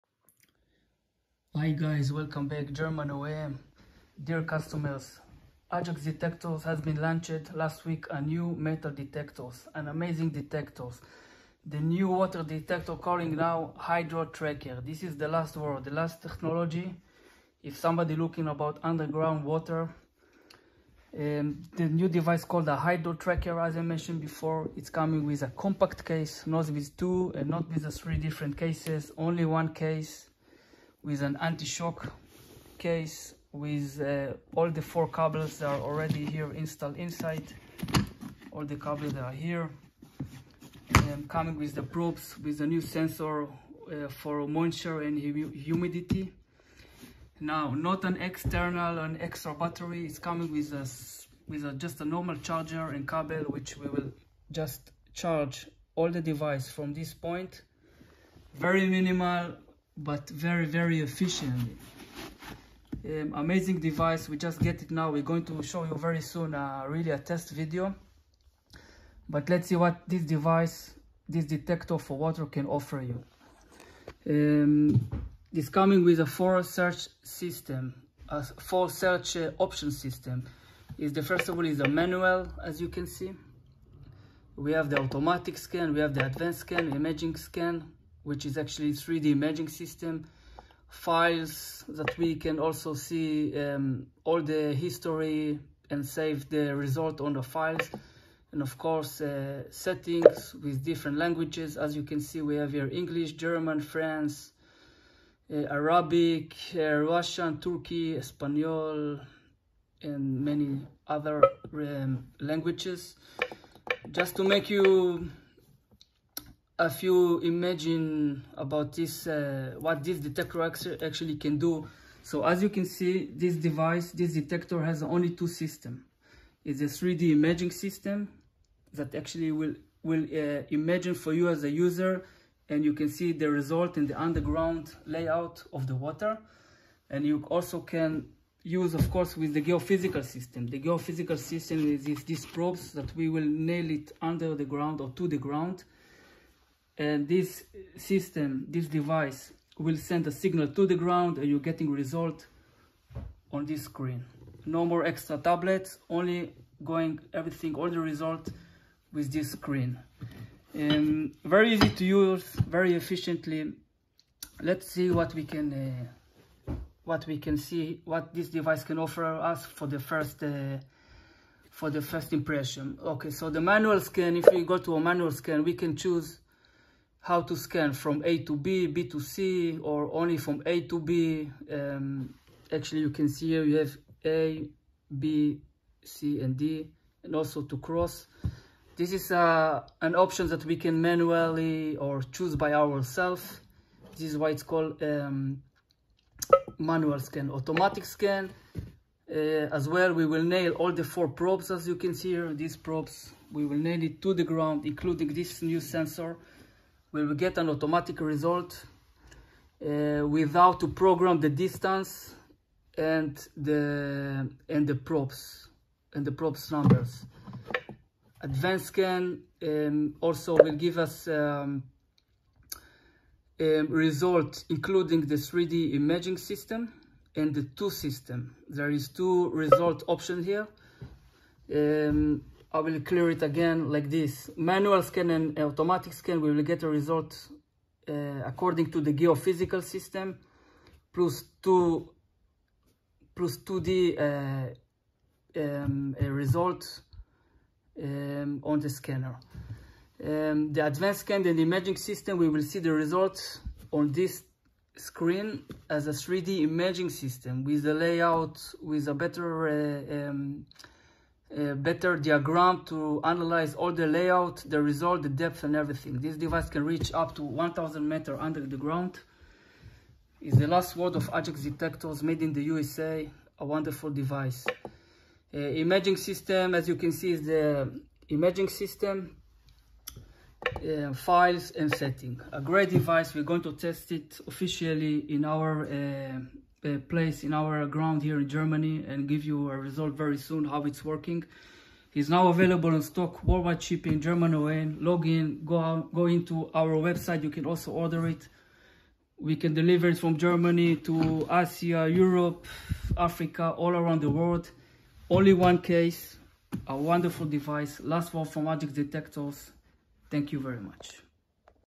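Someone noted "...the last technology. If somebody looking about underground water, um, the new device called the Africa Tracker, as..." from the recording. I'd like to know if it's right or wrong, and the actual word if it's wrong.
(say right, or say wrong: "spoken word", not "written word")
wrong: "Hydro", not "Africa".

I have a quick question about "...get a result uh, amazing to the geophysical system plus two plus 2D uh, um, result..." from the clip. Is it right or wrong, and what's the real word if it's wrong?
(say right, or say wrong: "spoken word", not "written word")
wrong: "according", not "amazing".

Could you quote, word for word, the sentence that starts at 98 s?
And of course, uh, settings with different languages.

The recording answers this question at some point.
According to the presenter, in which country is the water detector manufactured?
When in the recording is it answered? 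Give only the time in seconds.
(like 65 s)
272 s.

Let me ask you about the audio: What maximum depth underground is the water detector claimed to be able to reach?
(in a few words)
1000 meters.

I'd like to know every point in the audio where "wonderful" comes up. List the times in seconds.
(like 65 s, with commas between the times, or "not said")
273 s, 306 s.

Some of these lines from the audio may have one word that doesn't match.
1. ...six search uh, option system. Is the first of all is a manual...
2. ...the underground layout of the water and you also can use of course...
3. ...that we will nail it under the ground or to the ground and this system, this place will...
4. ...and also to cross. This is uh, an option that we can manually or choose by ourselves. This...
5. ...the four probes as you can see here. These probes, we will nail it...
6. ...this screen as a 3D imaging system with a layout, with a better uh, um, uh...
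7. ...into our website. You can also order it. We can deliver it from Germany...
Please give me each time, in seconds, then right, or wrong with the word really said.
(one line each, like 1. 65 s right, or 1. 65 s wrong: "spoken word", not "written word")
1. 78 s wrong: "four", not "six"
2. 134 s right
3. 142 s wrong: "device", not "place"
4. 187 s right
5. 200 s right
6. 254 s right
7. 296 s right.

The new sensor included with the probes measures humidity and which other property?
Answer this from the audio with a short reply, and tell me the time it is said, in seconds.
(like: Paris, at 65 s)
moisture, at 44 s.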